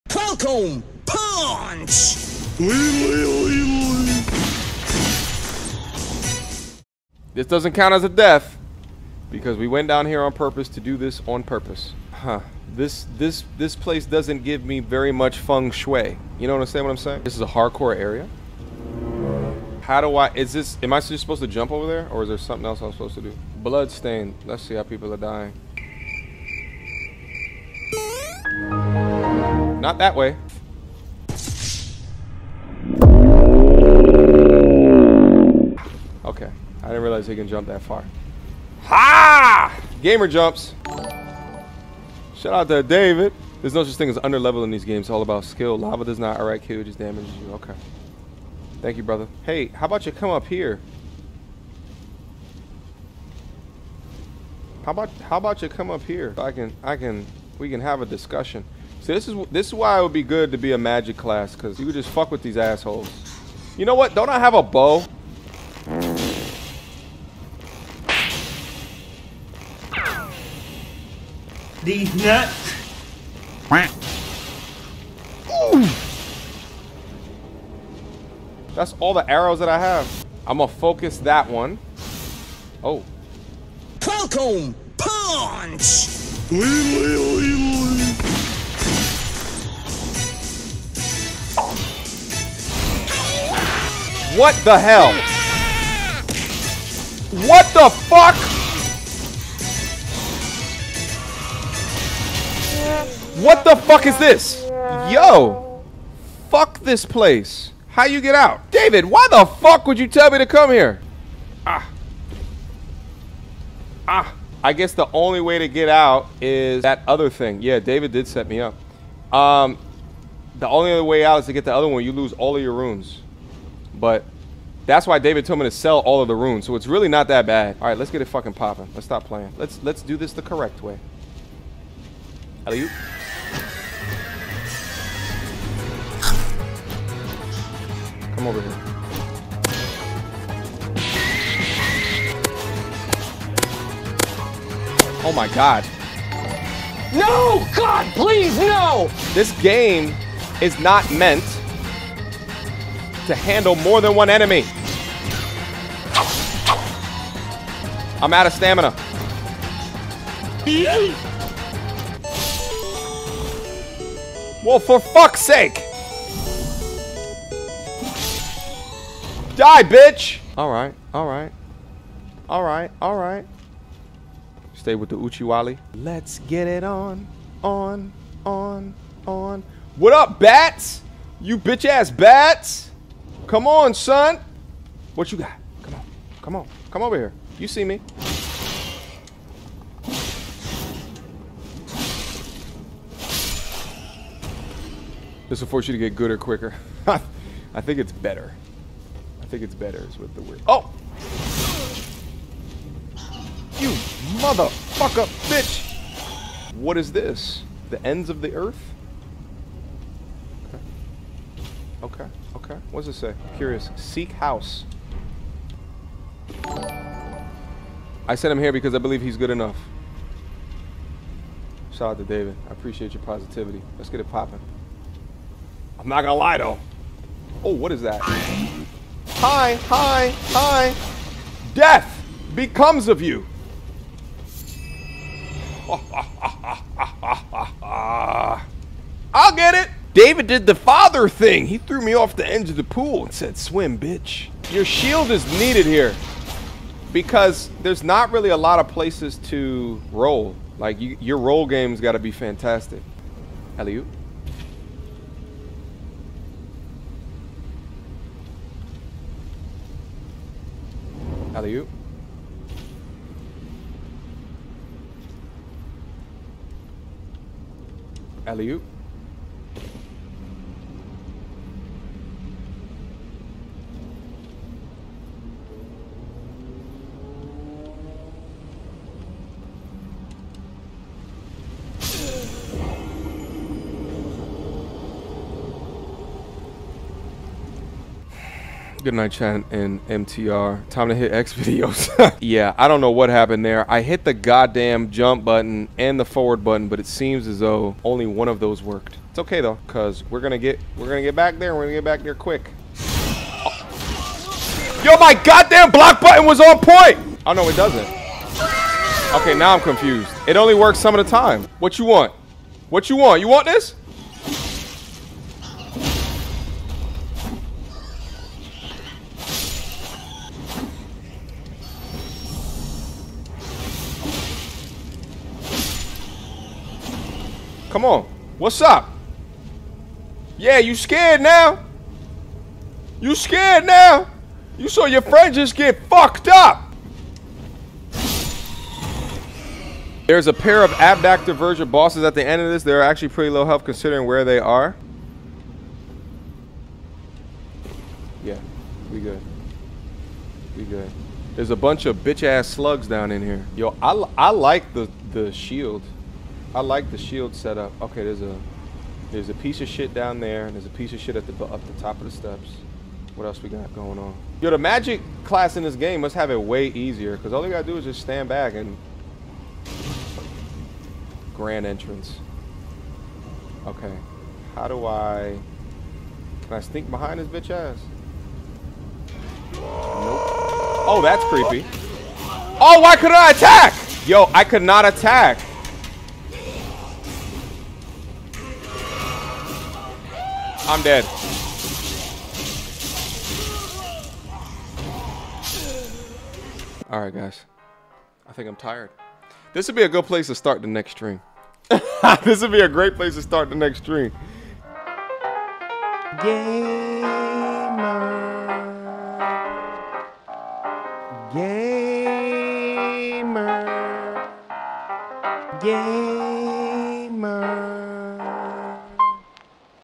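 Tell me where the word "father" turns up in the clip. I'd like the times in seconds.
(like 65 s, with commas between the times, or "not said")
240 s.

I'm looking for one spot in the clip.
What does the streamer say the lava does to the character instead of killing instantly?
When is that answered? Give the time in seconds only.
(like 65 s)
46 s.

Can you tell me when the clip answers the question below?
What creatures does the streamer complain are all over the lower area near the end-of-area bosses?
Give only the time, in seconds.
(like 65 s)
352 s.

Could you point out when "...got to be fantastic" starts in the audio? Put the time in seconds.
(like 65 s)
252 s.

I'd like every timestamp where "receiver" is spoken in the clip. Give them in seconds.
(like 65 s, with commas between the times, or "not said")
not said.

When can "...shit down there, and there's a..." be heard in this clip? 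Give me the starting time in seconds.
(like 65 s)
359 s.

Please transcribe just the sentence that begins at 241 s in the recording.
He threw me off the edge of the pool and said, swim, bitch.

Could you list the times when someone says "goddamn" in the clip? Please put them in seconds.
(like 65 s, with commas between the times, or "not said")
294 s, 305 s.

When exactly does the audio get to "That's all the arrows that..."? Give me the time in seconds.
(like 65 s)
78 s.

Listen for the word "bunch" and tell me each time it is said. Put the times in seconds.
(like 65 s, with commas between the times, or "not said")
351 s.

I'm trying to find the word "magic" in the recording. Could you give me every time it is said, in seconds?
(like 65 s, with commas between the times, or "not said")
60 s, 364 s.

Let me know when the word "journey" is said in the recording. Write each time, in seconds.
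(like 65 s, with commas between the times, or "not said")
not said.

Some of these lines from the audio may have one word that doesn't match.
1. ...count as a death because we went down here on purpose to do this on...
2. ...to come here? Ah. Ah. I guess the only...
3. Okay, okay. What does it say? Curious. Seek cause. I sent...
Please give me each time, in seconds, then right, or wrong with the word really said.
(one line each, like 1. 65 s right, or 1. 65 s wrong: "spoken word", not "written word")
1. 7 s right
2. 110 s right
3. 212 s wrong: "house", not "cause".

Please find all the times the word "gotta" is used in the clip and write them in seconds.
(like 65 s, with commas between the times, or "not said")
367 s.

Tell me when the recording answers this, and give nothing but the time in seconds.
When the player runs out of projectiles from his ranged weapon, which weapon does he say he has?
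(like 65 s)
64 s.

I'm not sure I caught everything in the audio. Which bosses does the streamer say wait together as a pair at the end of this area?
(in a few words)
Abductor Virgins.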